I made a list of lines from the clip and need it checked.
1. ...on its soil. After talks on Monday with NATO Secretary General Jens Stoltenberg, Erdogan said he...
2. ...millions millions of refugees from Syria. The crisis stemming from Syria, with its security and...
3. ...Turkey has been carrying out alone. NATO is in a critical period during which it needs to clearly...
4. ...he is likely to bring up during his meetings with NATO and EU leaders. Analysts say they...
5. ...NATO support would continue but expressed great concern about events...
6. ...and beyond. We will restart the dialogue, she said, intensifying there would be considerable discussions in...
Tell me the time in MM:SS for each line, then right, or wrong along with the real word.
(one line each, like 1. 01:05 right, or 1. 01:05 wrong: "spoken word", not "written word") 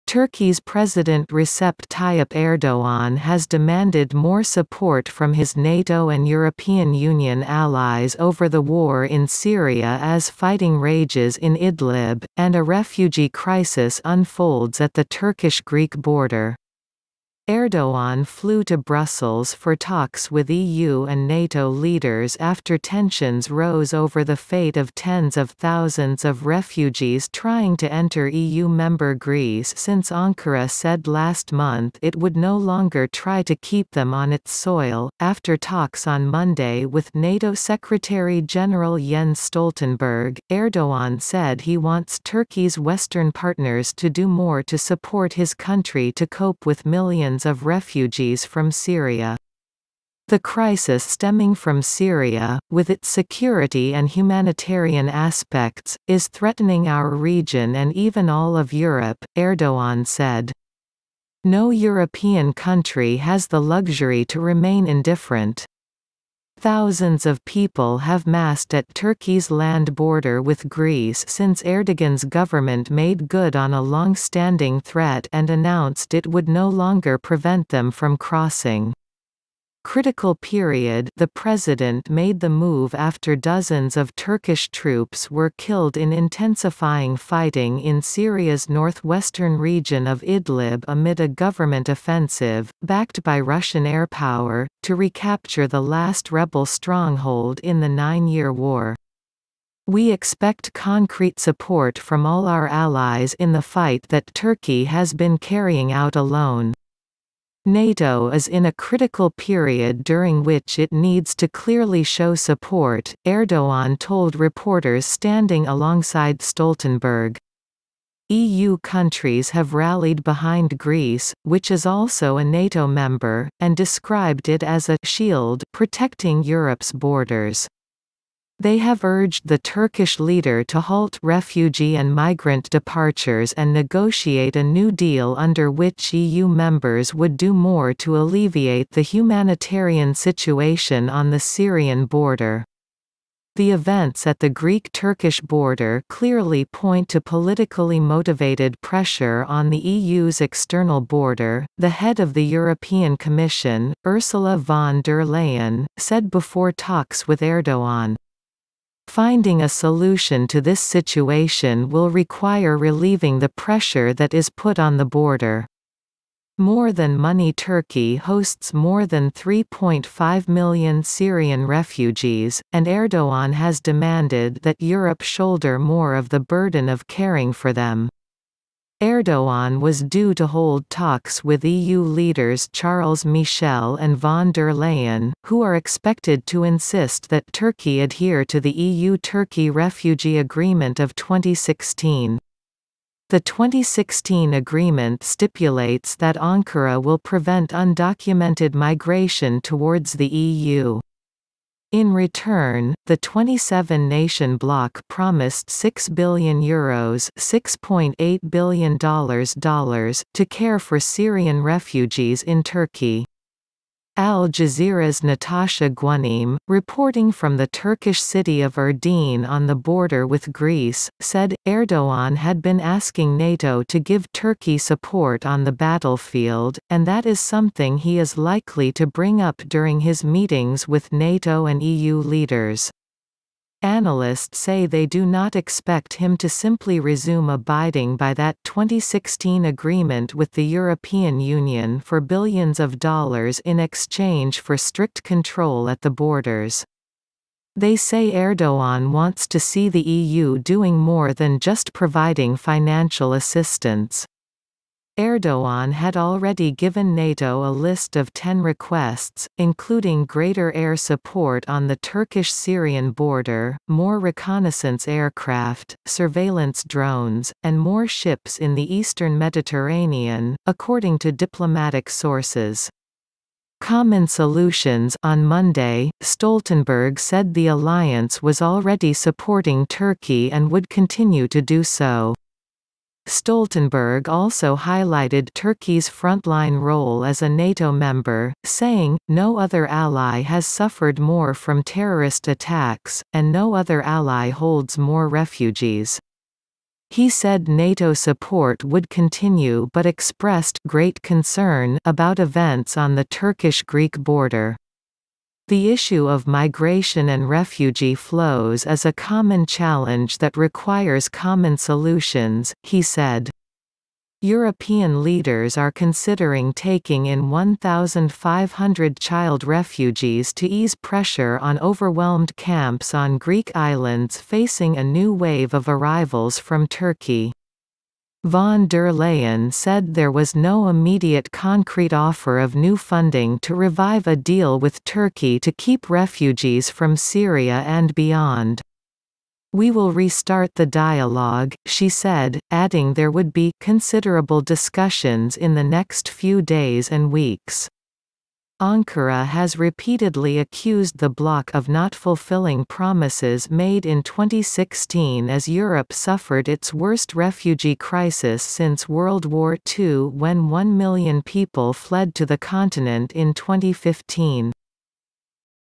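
1. 00:34 right
2. 00:46 right
3. 01:44 right
4. 03:47 right
5. 04:57 right
6. 05:37 wrong: "adding", not "intensifying".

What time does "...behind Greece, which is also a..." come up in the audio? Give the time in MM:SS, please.
02:00.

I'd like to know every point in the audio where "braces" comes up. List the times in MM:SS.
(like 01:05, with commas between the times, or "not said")
not said.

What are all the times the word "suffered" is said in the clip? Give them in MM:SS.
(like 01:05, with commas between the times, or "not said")
04:50, 05:56.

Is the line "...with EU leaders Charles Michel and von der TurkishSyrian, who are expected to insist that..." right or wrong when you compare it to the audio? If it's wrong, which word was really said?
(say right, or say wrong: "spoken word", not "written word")
wrong: "Leyen", not "TurkishSyrian".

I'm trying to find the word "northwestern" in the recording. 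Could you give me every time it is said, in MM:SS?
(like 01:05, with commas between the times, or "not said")
01:28.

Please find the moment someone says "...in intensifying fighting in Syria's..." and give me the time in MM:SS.
01:25.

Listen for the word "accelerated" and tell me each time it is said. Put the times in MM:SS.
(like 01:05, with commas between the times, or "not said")
not said.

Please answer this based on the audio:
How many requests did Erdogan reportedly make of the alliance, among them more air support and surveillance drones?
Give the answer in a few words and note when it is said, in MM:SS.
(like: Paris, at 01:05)
10, at 04:18.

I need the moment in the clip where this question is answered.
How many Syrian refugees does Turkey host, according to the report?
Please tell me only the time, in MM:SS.
02:48.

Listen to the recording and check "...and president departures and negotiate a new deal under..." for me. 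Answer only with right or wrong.
wrong.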